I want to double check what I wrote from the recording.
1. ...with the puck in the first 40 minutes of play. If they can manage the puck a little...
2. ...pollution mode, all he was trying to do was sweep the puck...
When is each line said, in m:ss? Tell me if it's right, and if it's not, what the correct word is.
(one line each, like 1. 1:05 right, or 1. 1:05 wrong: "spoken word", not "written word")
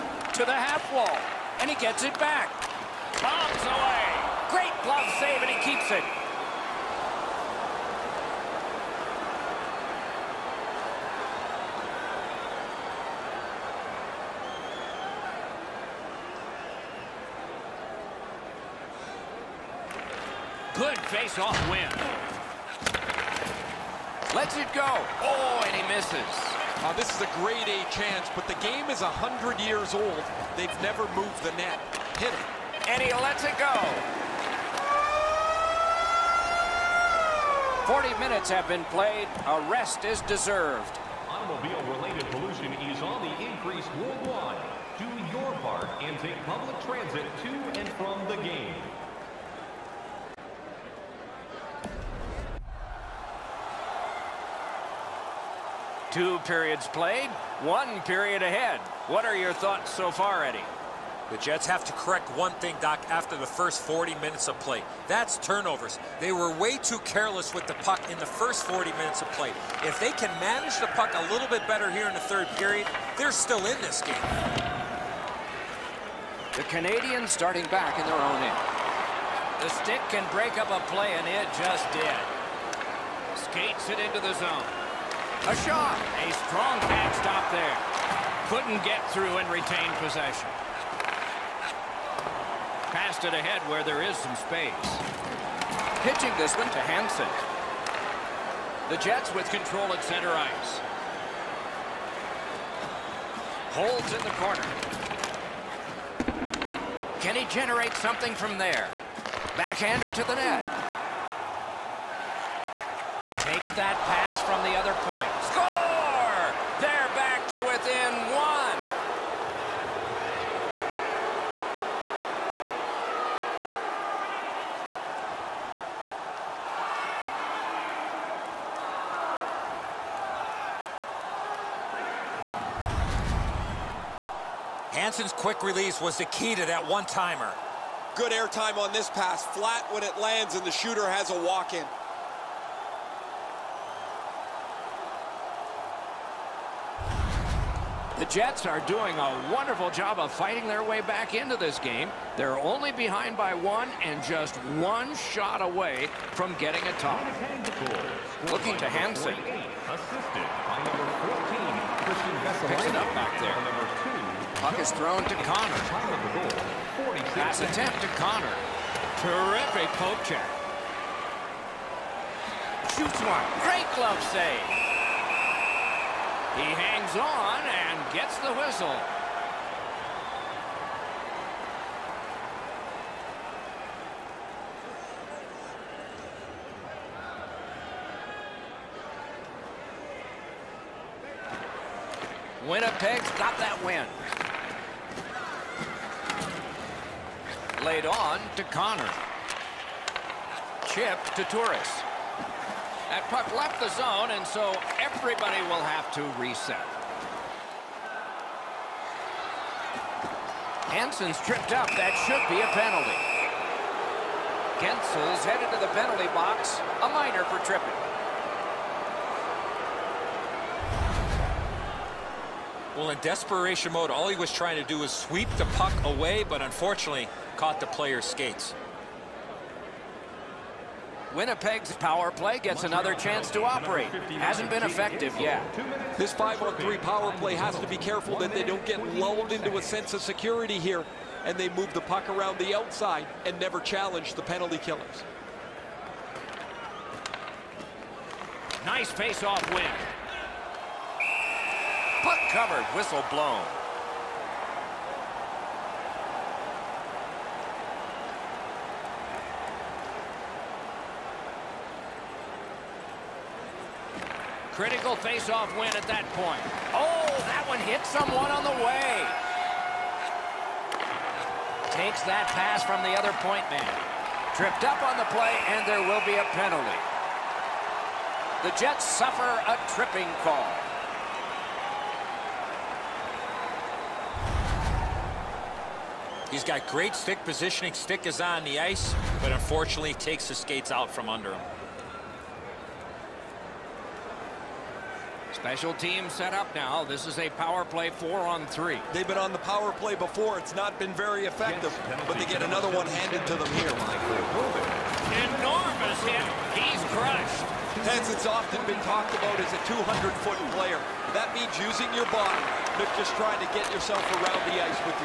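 1. 1:07 right
2. 3:43 wrong: "desperation", not "pollution".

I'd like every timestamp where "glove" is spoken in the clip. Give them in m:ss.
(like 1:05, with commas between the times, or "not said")
0:04, 2:53.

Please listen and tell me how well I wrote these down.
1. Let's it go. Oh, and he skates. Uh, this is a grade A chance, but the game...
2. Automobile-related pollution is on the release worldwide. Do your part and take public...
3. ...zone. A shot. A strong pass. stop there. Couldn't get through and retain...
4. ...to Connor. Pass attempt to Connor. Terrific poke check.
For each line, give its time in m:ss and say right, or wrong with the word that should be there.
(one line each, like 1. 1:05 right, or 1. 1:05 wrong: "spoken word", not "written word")
1. 0:24 wrong: "misses", not "skates"
2. 0:41 wrong: "increase", not "release"
3. 1:24 right
4. 2:45 right.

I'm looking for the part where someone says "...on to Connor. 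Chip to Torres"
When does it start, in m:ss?
3:18.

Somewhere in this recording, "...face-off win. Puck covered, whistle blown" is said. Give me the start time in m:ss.
4:09.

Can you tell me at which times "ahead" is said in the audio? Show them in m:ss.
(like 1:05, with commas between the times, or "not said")
0:58, 1:33.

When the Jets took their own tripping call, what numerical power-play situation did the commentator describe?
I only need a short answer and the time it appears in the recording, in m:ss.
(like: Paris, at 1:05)
Four on three, at 4:58.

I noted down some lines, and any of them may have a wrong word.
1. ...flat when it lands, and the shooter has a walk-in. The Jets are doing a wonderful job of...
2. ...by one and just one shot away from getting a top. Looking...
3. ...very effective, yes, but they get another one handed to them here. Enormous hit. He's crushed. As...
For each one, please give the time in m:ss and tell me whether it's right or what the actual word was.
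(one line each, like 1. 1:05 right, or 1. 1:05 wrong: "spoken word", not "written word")
1. 2:19 right
2. 2:33 right
3. 5:01 right.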